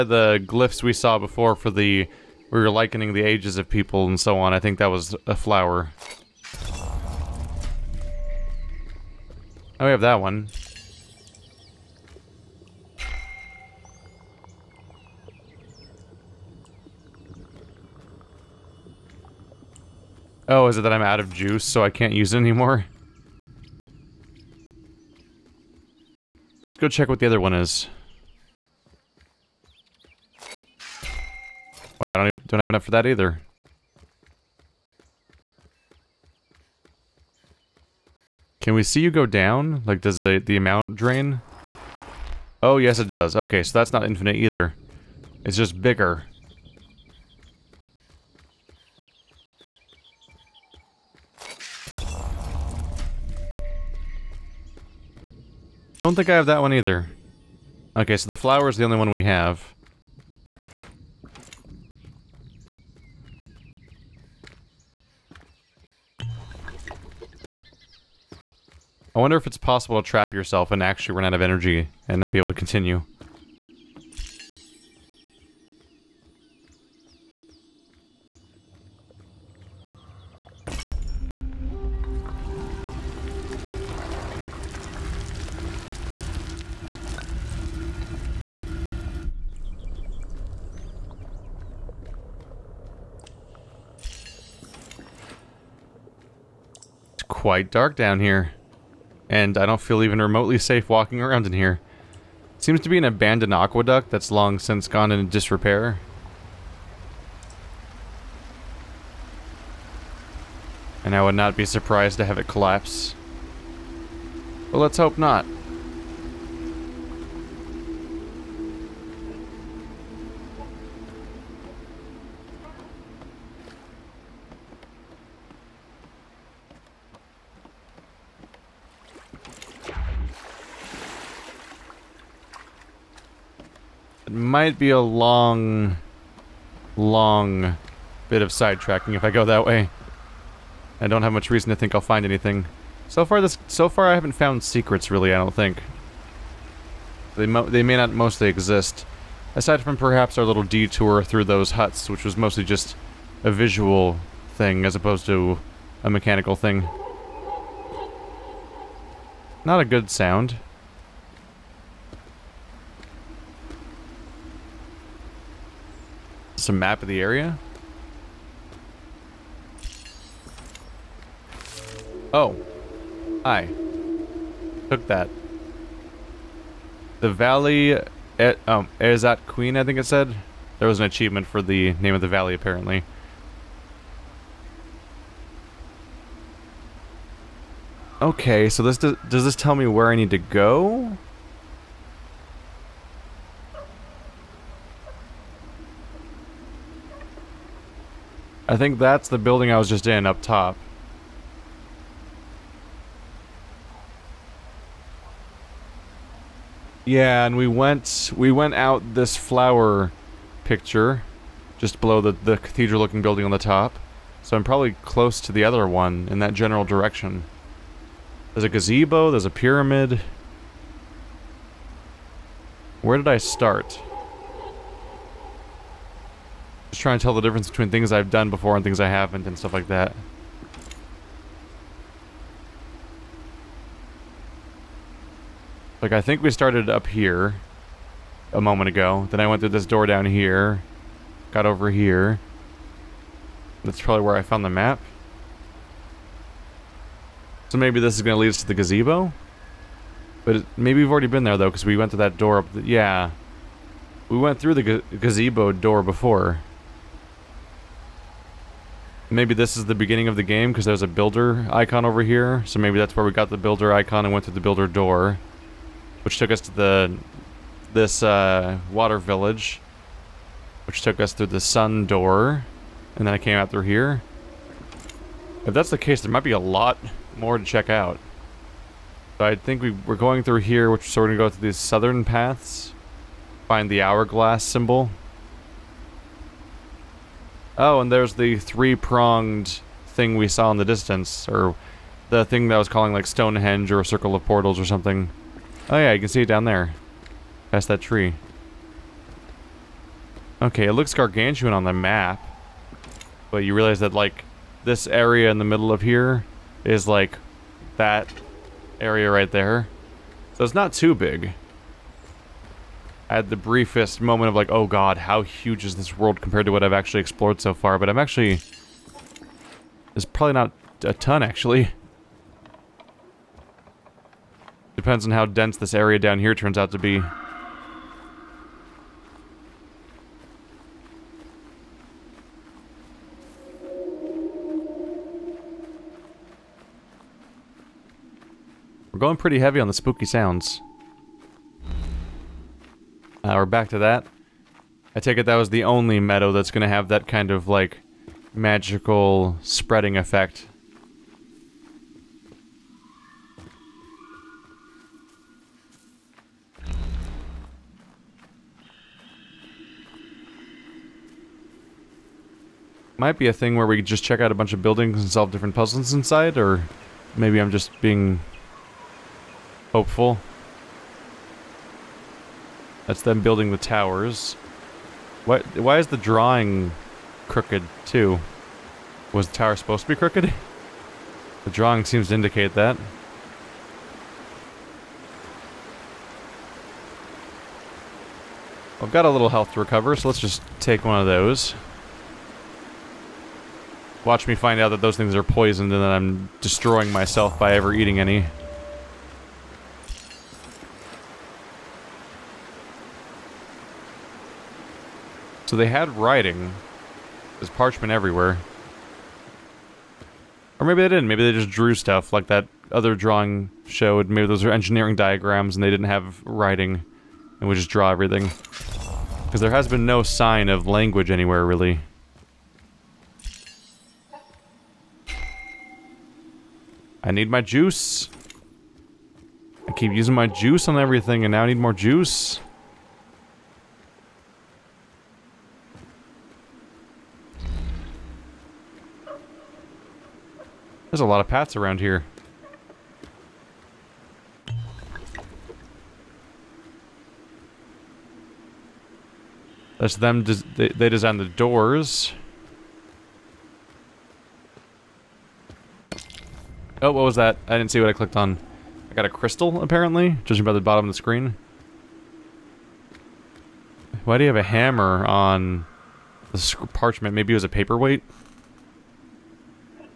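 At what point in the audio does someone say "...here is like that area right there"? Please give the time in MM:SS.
05:06.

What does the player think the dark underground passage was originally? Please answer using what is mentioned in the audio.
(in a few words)
An abandoned aqueduct.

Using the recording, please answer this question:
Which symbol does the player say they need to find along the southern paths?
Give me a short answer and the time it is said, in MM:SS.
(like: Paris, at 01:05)
The hourglass symbol, at 04:44.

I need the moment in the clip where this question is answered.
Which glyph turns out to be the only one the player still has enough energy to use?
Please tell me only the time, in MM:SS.
00:58.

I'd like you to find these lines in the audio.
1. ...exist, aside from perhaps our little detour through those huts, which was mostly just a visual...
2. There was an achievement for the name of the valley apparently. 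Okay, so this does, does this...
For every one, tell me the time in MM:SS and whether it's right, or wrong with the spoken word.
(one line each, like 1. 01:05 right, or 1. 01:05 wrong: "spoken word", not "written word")
1. 02:28 right
2. 03:00 right.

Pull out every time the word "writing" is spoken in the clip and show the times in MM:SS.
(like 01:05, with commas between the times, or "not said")
06:46, 06:56.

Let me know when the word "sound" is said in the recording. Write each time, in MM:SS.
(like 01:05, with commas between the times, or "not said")
02:40, 05:40.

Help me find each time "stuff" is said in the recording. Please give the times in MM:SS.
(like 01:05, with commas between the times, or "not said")
03:49, 06:51.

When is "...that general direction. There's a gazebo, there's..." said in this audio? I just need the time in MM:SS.
03:36.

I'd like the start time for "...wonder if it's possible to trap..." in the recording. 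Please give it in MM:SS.
01:09.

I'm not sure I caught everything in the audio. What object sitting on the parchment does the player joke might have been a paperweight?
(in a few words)
A hammer.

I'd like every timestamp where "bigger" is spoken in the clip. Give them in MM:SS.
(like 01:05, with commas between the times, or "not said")
00:45.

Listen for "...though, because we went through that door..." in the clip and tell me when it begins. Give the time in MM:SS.
04:11.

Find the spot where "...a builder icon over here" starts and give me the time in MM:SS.
04:21.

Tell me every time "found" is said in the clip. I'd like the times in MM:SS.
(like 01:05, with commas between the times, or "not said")
02:24, 04:04.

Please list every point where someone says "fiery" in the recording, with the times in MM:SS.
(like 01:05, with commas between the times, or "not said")
not said.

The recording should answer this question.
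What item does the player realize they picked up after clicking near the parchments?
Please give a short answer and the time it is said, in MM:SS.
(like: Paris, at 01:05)
A crystal, at 07:39.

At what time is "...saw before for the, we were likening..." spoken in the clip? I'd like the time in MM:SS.
00:00.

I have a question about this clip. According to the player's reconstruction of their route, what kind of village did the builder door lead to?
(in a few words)
Water village.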